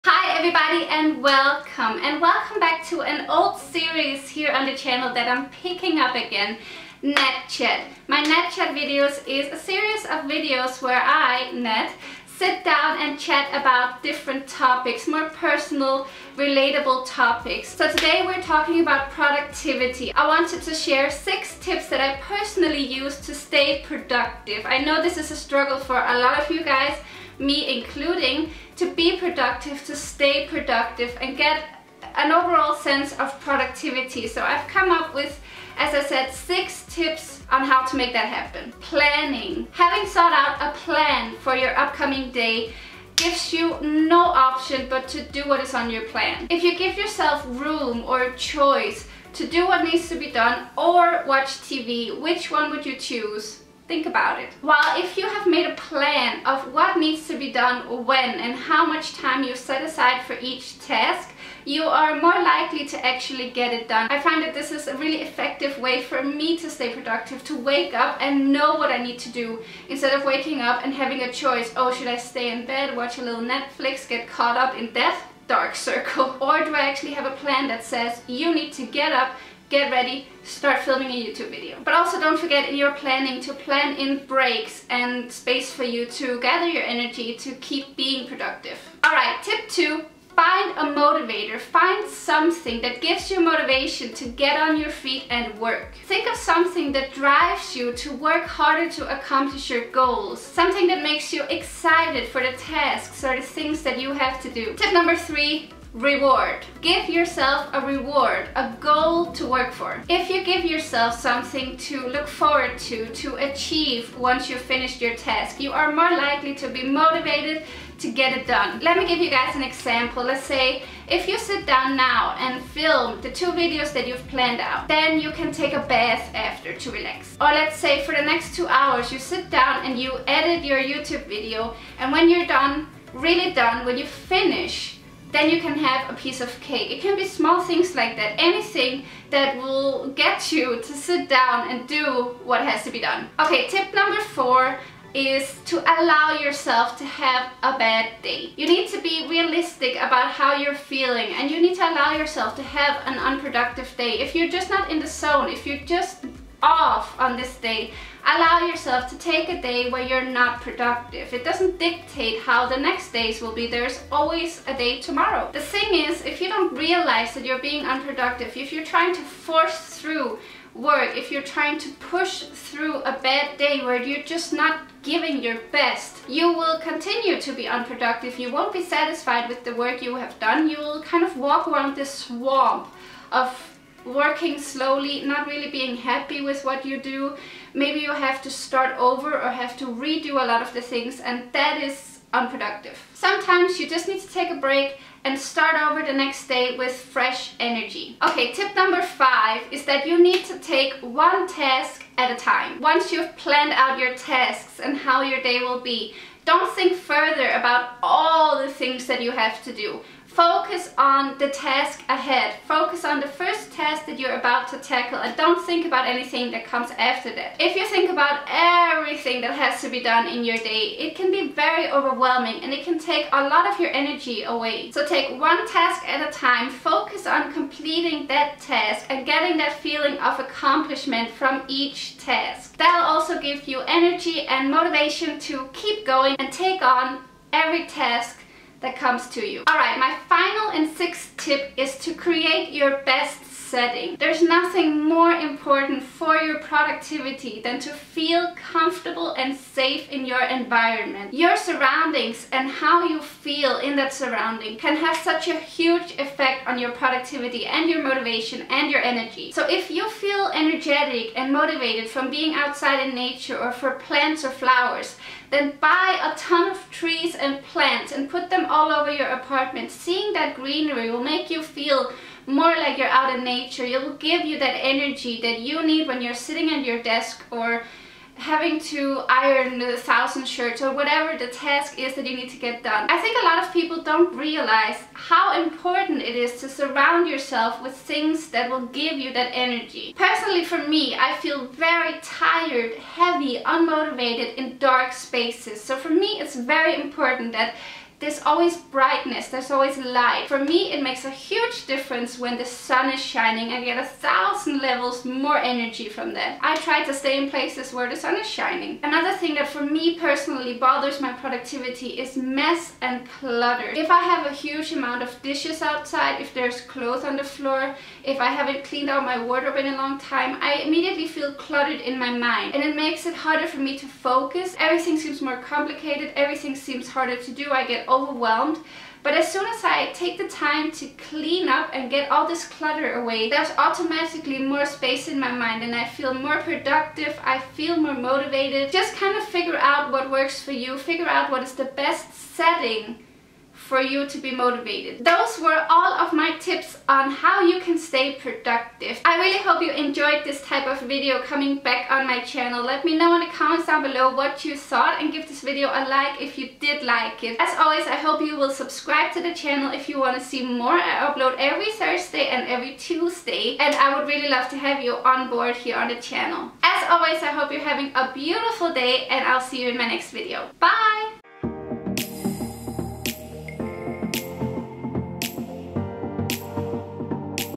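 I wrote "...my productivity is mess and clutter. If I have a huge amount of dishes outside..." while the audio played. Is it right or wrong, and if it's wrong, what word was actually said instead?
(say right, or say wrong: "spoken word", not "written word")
right.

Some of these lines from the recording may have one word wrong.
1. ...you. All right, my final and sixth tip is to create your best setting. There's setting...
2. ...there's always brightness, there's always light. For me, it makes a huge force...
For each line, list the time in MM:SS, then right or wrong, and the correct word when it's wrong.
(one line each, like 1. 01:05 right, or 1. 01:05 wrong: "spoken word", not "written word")
1. 03:59 wrong: "nothing", not "setting"
2. 04:58 wrong: "difference", not "force".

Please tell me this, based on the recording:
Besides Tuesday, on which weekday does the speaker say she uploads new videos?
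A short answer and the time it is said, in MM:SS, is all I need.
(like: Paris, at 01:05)
Thursday, at 06:01.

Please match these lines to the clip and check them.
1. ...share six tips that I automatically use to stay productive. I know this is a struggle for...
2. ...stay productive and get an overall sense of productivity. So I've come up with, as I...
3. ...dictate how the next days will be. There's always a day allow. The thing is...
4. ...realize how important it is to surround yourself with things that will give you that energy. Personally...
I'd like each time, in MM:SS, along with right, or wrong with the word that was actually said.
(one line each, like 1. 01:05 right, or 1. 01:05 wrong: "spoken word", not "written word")
1. 00:20 wrong: "personally", not "automatically"
2. 00:29 right
3. 02:41 wrong: "tomorrow", not "allow"
4. 04:44 right.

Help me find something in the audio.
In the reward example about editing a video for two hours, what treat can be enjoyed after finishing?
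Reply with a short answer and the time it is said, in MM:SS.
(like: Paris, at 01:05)
a piece of cake, at 02:16.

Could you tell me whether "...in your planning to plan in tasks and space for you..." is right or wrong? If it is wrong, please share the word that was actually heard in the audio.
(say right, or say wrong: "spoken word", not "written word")
wrong: "breaks", not "tasks".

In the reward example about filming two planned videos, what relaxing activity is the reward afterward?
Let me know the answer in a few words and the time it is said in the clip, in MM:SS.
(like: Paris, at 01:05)
take a bath, at 02:05.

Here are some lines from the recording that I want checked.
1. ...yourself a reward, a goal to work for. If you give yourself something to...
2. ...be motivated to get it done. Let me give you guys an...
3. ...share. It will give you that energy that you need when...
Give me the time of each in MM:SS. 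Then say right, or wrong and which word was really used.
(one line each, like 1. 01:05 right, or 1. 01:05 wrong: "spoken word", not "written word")
1. 01:47 right
2. 01:56 right
3. 04:33 wrong: "nature", not "share".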